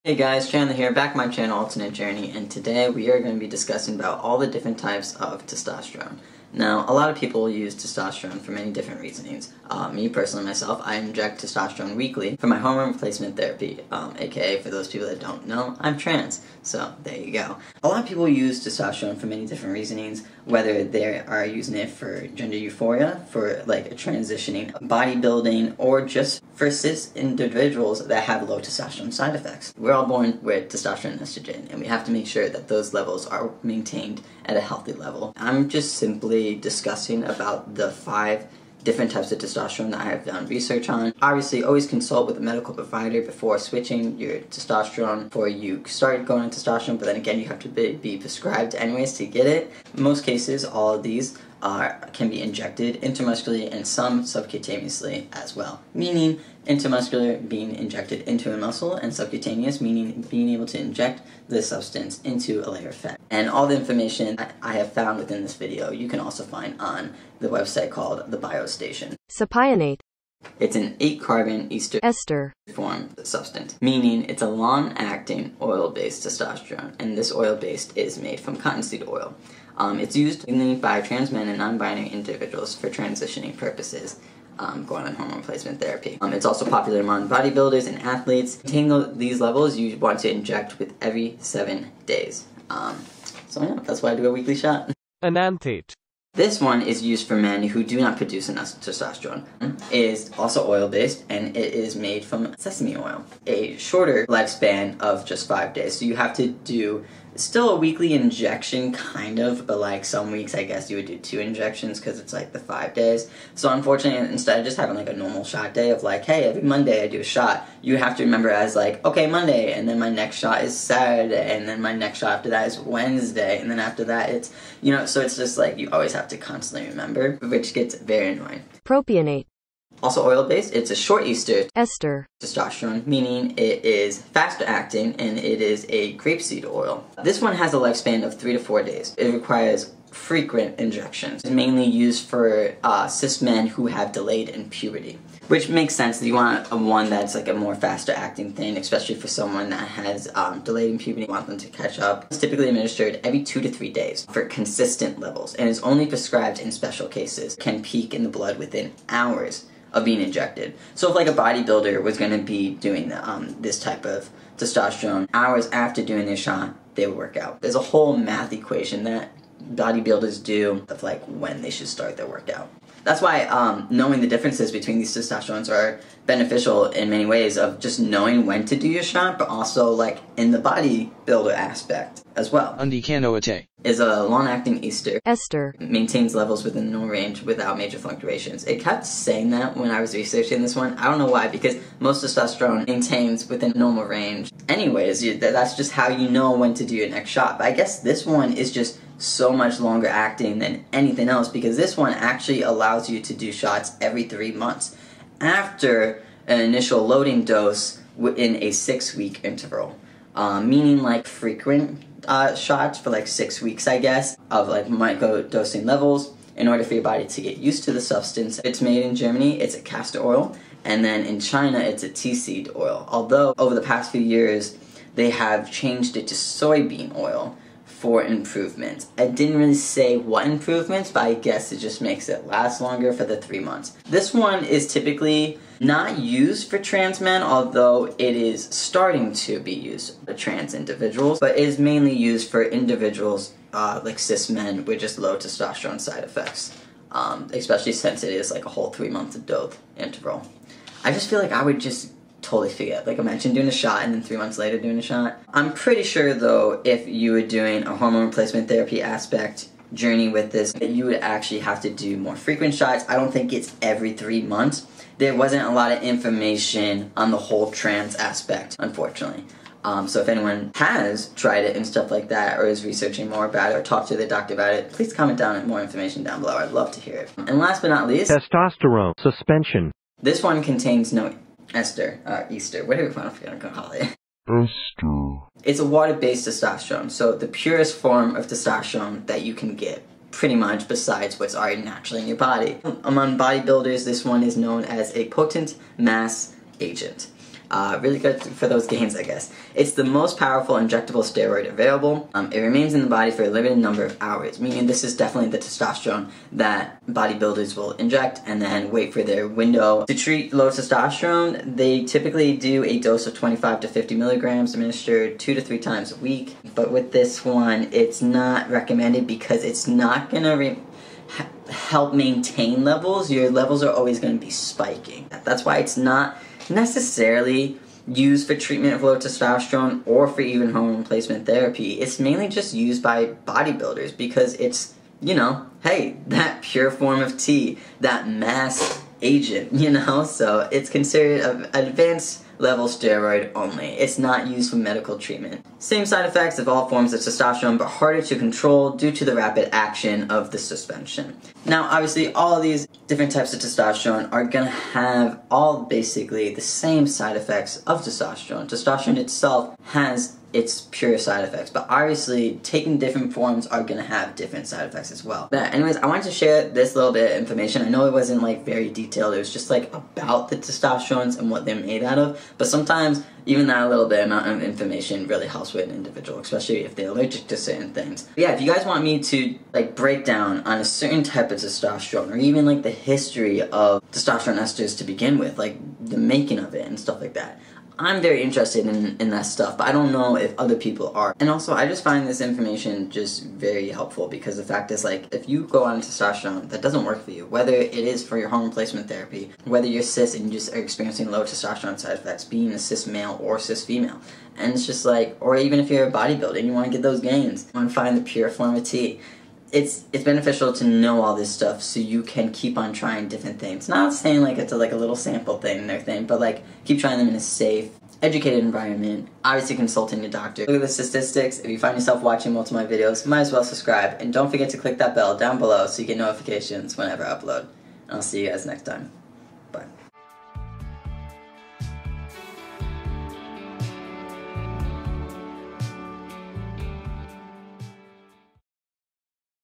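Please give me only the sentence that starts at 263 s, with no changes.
I don't think it's every three months.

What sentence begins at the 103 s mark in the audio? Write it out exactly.
A shorter lifespan of just five days.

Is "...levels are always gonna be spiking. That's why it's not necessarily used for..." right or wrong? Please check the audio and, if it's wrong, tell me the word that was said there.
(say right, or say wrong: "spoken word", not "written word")
right.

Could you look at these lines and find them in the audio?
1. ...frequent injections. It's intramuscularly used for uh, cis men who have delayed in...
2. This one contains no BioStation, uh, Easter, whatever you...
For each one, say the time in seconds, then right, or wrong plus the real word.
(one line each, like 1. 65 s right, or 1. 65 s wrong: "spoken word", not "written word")
1. 140 s wrong: "mainly", not "intramuscularly"
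2. 280 s wrong: "Esther", not "BioStation".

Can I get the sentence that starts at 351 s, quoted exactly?
Now, obviously, all these different types of testosterone are gonna have all basically the same side effects of testosterone.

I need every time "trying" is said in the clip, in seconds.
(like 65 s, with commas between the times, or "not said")
412 s, 416 s.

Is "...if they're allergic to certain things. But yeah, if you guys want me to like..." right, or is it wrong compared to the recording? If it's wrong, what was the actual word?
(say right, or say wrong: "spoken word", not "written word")
right.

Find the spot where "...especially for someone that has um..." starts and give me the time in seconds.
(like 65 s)
148 s.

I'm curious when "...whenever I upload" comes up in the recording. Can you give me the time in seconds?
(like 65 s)
426 s.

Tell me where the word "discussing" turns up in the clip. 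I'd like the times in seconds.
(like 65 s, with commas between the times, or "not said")
3 s, 36 s.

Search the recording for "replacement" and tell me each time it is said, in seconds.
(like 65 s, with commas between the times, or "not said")
12 s, 85 s, 258 s, 330 s, 398 s.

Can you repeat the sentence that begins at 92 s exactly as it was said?
Um, so yeah, that's why I do a weekly shot.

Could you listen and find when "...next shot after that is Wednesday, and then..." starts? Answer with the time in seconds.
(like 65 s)
121 s.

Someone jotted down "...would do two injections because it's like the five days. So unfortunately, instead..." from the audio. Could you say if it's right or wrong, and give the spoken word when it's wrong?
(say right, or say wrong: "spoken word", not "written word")
right.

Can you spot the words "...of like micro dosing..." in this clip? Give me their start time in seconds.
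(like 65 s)
214 s.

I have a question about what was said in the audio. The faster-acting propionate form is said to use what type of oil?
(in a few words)
Grapeseed oil.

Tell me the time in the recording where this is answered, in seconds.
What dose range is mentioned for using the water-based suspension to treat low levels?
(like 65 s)
313 s.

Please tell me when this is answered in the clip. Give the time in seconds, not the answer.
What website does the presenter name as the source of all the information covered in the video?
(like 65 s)
68 s.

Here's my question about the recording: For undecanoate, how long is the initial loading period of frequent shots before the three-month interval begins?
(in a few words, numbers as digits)
6 weeks.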